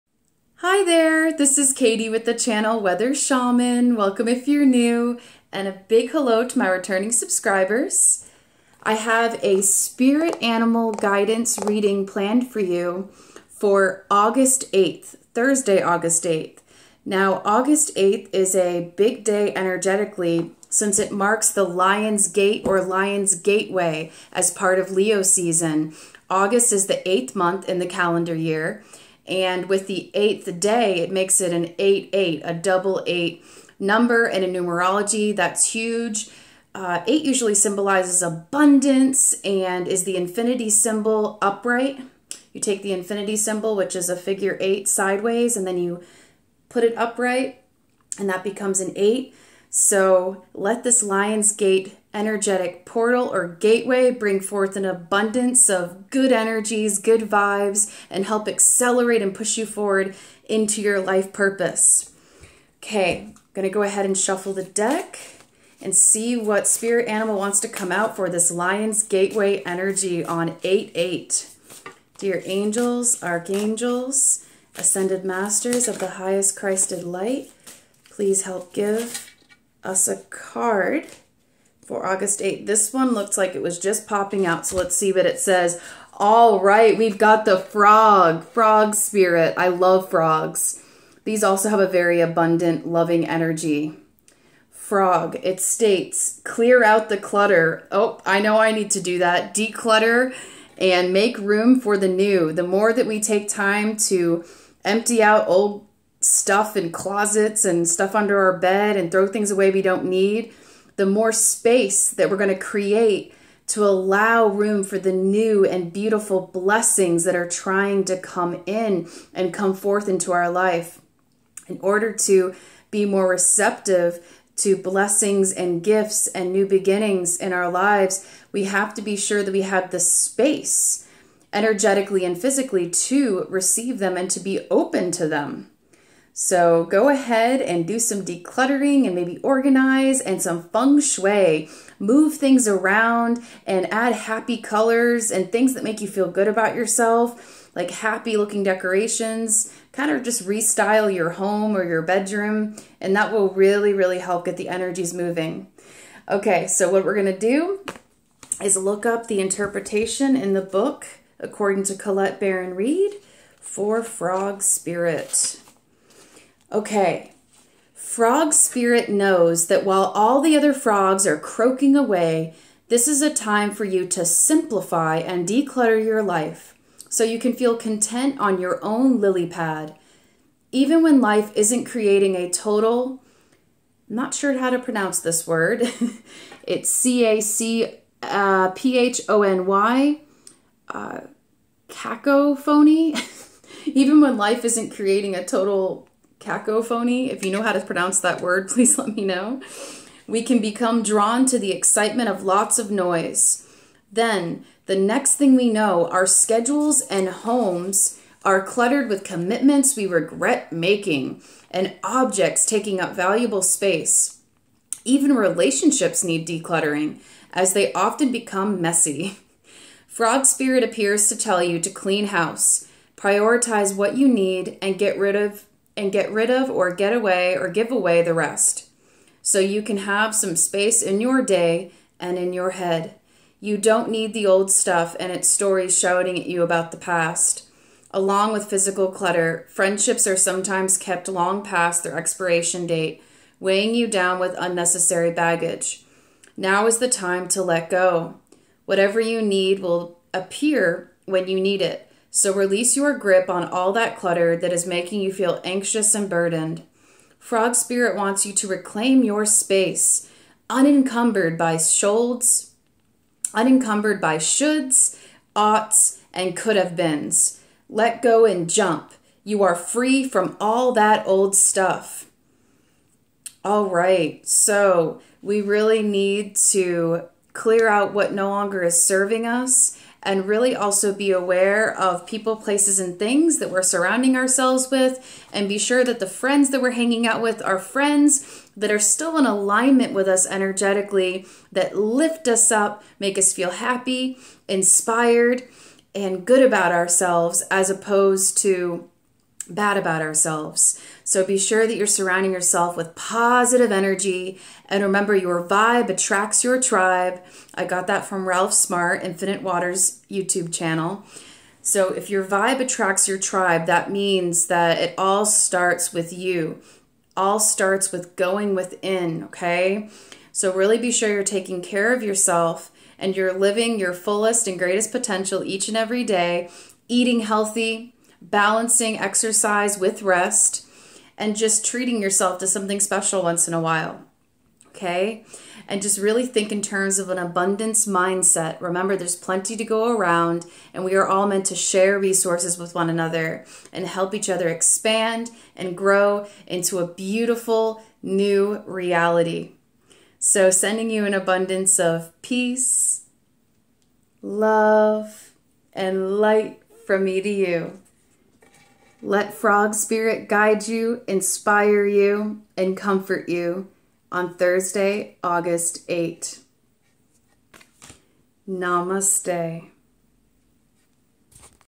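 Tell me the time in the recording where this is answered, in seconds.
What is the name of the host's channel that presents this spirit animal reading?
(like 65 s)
2 s.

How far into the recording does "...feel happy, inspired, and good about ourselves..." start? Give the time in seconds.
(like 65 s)
293 s.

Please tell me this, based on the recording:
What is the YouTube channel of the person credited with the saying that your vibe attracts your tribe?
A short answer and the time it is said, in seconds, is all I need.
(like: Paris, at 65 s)
Infinite Waters, at 309 s.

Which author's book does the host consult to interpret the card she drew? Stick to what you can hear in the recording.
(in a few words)
Colette Baron Reid.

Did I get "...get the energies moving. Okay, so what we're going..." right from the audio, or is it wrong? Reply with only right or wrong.
right.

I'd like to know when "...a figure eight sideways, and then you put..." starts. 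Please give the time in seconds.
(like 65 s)
44 s.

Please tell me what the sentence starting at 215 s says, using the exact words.
Even relationships need decluttering, as they often become messy.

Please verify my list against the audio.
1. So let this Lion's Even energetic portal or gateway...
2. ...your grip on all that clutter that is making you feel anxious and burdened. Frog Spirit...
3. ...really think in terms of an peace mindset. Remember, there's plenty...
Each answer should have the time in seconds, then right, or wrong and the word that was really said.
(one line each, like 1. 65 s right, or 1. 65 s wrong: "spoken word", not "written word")
1. 49 s wrong: "Gate", not "Even"
2. 252 s right
3. 336 s wrong: "abundance", not "peace".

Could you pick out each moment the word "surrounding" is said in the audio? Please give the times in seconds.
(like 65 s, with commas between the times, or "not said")
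283 s, 302 s.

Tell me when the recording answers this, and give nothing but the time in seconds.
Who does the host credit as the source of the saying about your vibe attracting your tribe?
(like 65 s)
308 s.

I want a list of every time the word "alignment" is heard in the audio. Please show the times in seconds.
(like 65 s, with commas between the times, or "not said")
289 s.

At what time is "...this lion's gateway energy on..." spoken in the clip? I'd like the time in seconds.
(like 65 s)
68 s.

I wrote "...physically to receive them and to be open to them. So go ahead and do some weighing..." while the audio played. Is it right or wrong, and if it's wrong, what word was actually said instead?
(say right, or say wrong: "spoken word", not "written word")
wrong: "decluttering", not "weighing".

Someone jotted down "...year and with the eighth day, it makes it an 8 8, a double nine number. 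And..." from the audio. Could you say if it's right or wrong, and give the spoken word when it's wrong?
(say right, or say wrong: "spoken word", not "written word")
wrong: "eight", not "nine".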